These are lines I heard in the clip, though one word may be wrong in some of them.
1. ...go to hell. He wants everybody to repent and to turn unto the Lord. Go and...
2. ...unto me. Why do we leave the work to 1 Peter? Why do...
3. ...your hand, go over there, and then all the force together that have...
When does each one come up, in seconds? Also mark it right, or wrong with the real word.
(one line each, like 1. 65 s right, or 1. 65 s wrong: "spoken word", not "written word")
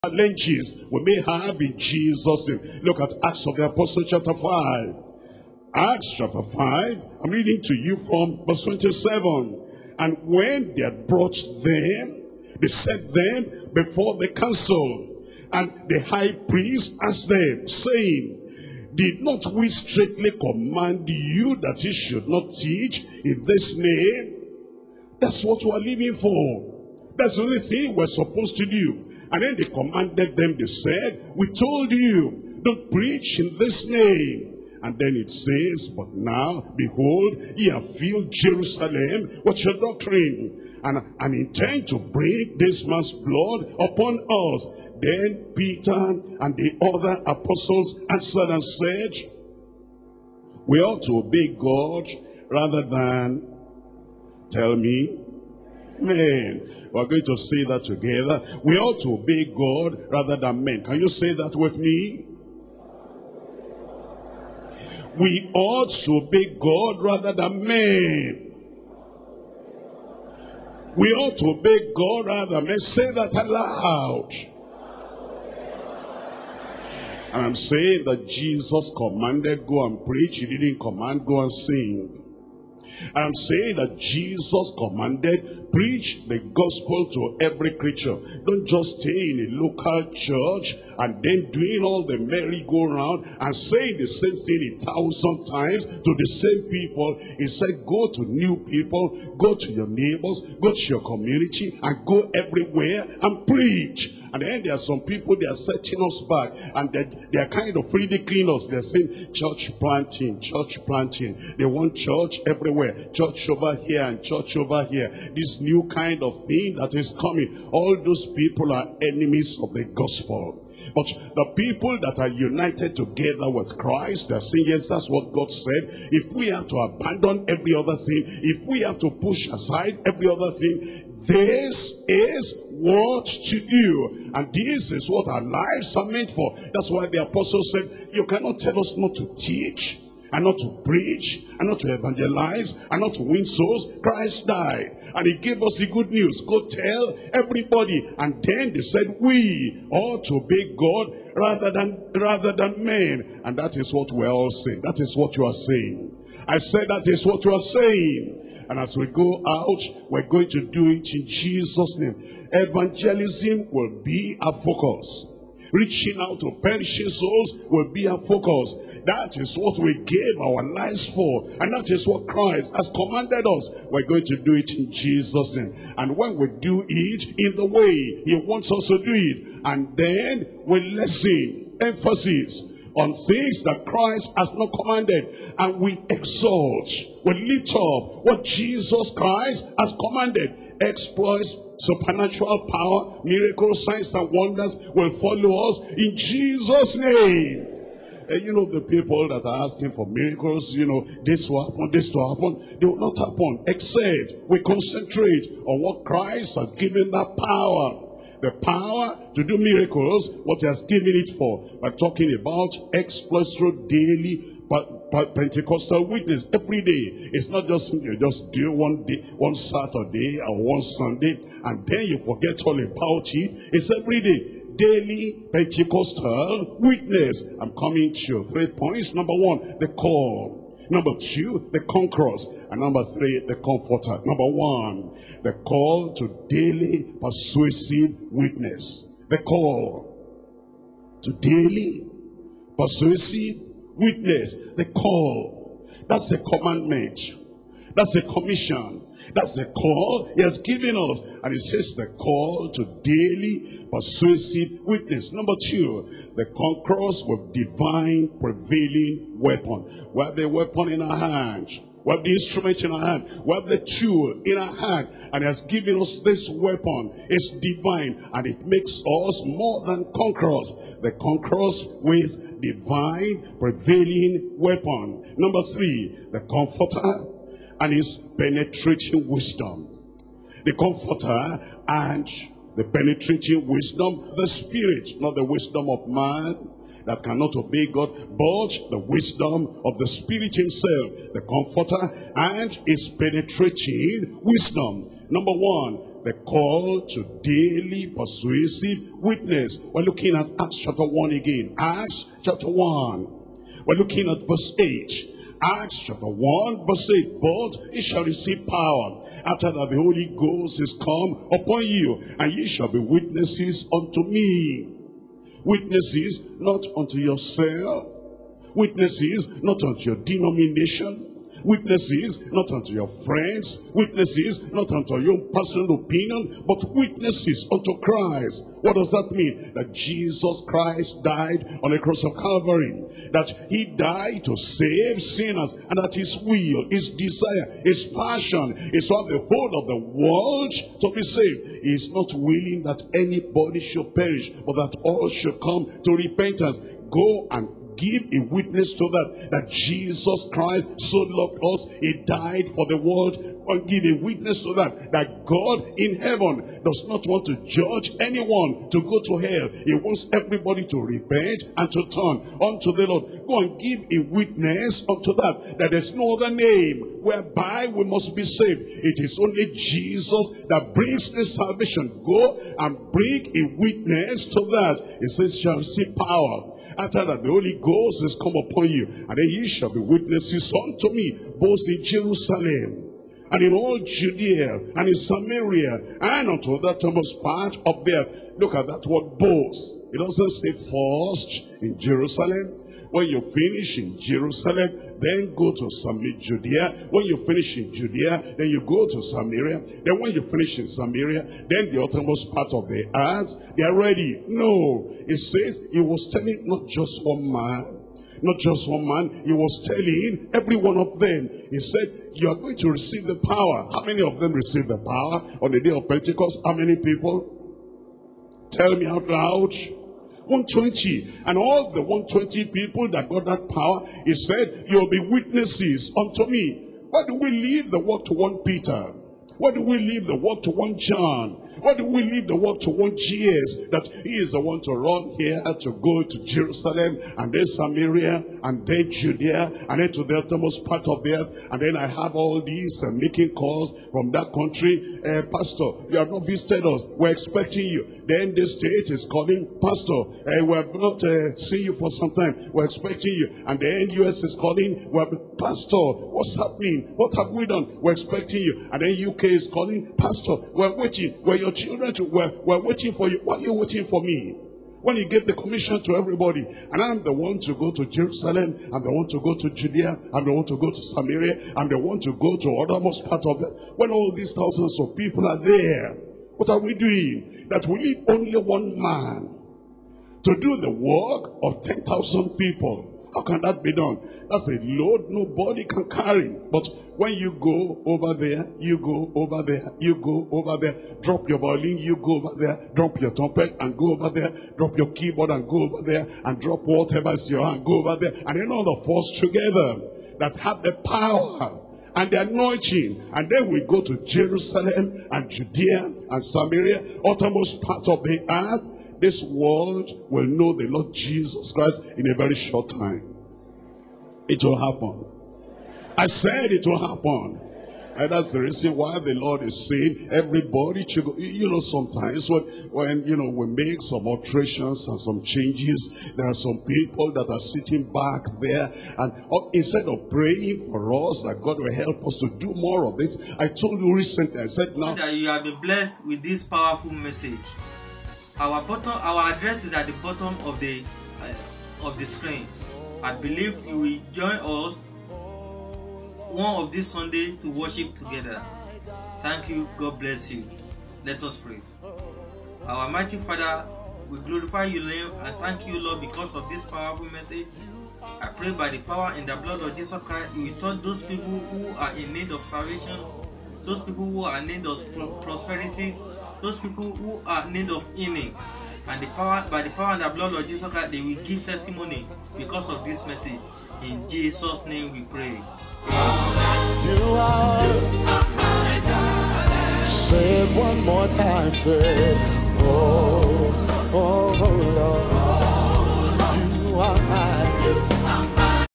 1. 359 s right
2. 426 s right
3. 497 s right.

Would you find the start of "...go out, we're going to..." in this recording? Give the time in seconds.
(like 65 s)
159 s.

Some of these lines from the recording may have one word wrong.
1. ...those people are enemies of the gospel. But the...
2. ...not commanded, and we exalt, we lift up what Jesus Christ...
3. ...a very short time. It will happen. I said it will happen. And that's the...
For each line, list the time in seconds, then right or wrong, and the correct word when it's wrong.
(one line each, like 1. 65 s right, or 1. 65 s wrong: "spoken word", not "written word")
1. 117 s right
2. 184 s right
3. 512 s right.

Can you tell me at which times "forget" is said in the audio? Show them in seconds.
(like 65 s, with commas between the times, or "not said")
222 s.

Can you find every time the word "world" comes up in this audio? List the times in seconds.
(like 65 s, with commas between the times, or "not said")
339 s, 352 s, 432 s, 509 s.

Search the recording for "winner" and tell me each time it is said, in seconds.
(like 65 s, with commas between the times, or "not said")
not said.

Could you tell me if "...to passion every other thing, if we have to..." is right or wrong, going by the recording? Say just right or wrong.
wrong.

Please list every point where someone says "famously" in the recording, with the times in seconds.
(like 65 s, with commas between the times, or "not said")
not said.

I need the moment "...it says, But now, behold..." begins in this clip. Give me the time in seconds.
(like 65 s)
35 s.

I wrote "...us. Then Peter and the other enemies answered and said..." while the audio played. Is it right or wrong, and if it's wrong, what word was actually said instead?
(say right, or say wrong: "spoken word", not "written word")
wrong: "apostles", not "enemies".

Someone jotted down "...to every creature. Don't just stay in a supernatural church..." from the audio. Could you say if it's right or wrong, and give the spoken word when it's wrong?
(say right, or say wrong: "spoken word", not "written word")
wrong: "local", not "supernatural".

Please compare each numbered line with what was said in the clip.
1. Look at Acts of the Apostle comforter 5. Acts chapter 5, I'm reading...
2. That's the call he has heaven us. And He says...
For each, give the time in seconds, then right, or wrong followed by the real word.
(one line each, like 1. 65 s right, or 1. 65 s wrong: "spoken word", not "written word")
1. 2 s wrong: "chapter", not "comforter"
2. 249 s wrong: "given", not "heaven".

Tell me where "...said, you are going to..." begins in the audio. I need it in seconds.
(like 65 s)
411 s.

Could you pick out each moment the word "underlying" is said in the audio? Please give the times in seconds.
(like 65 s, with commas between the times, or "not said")
not said.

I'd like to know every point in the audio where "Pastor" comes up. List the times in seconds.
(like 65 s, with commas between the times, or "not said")
445 s, 449 s, 455 s, 460 s.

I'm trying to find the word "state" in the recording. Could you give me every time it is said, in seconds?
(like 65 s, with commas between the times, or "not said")
448 s.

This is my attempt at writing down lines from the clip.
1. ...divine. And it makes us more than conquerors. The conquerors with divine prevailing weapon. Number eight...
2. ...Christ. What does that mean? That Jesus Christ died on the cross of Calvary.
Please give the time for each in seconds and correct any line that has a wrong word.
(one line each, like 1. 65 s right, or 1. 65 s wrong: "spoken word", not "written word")
1. 267 s wrong: "three", not "eight"
2. 327 s right.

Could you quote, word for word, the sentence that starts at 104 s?
And then there are some people, they are setting us back.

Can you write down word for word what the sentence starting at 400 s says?
Then when you finish in Samaria, then the uttermost part of the earth, they are ready.